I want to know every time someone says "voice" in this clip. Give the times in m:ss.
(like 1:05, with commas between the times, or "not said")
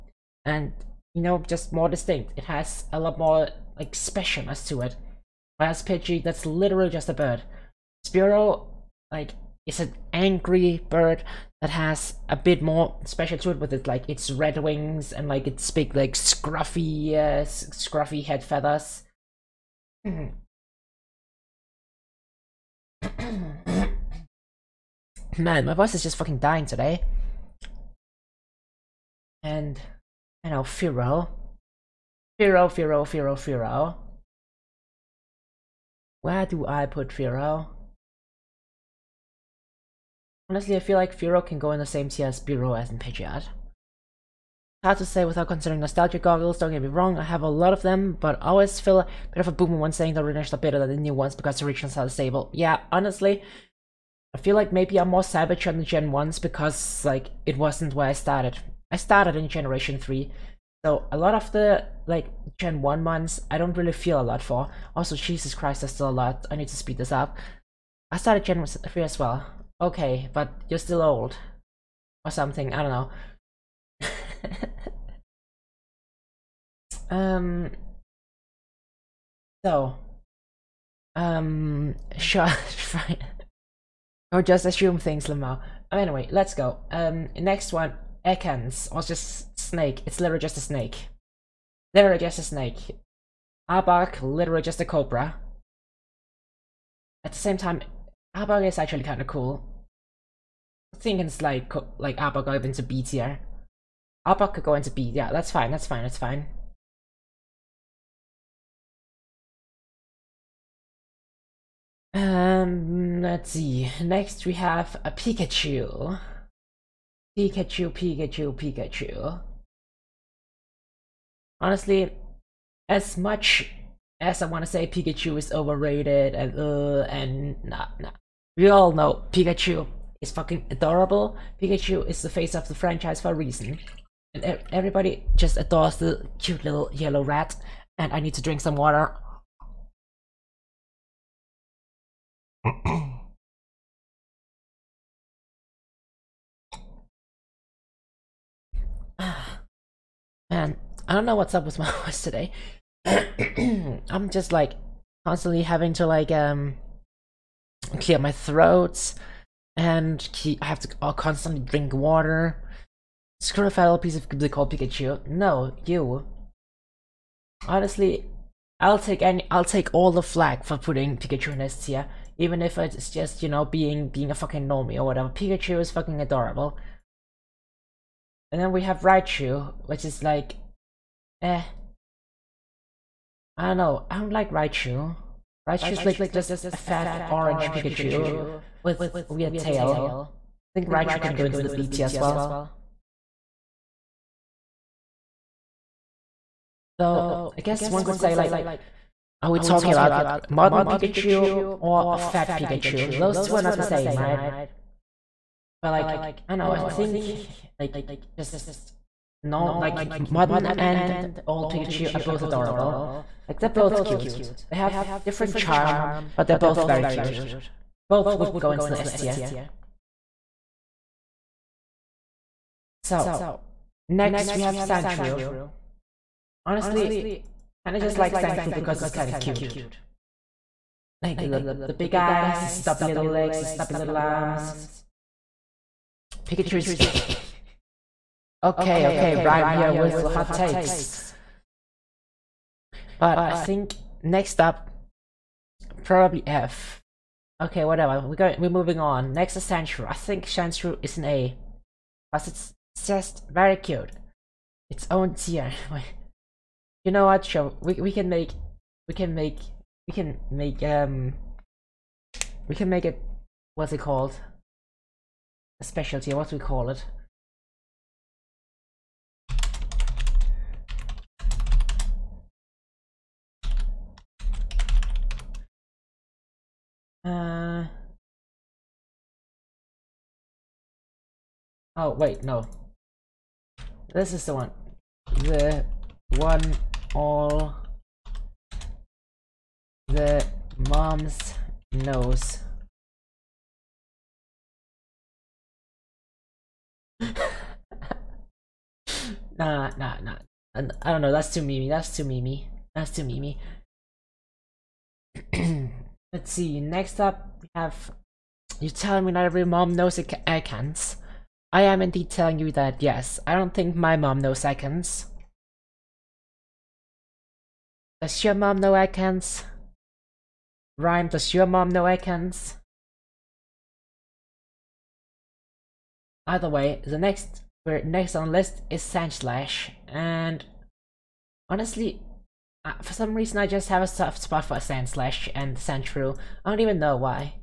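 0:25, 2:32.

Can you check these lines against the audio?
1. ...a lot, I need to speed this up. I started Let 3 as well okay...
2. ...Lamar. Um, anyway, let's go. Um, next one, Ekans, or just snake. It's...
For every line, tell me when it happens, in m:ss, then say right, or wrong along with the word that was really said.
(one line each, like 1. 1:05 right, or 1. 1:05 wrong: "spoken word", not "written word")
1. 1:06 wrong: "Gen", not "Let"
2. 1:25 right.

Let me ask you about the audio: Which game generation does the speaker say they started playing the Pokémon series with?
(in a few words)
Generation 3.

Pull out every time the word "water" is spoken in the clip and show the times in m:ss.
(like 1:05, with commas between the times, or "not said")
2:18, 2:41.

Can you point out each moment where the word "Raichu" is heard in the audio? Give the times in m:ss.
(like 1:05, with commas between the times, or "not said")
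2:59, 3:04, 3:10.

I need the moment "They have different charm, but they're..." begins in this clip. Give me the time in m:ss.
3:34.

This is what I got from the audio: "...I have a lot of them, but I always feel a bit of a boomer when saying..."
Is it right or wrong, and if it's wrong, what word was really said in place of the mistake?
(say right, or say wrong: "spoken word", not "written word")
right.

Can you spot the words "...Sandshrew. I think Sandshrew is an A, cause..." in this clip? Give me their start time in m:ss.
4:09.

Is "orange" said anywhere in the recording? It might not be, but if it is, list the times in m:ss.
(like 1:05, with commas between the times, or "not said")
3:07.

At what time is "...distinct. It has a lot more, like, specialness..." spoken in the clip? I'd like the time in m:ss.
0:01.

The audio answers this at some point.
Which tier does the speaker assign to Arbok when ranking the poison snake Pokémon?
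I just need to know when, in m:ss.
1:42.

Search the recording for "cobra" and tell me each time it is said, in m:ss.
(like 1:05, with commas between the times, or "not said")
1:34.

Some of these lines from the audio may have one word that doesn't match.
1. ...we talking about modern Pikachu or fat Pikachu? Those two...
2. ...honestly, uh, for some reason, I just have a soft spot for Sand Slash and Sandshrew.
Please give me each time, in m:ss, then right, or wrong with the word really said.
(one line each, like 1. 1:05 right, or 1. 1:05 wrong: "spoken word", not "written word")
1. 3:19 right
2. 5:31 right.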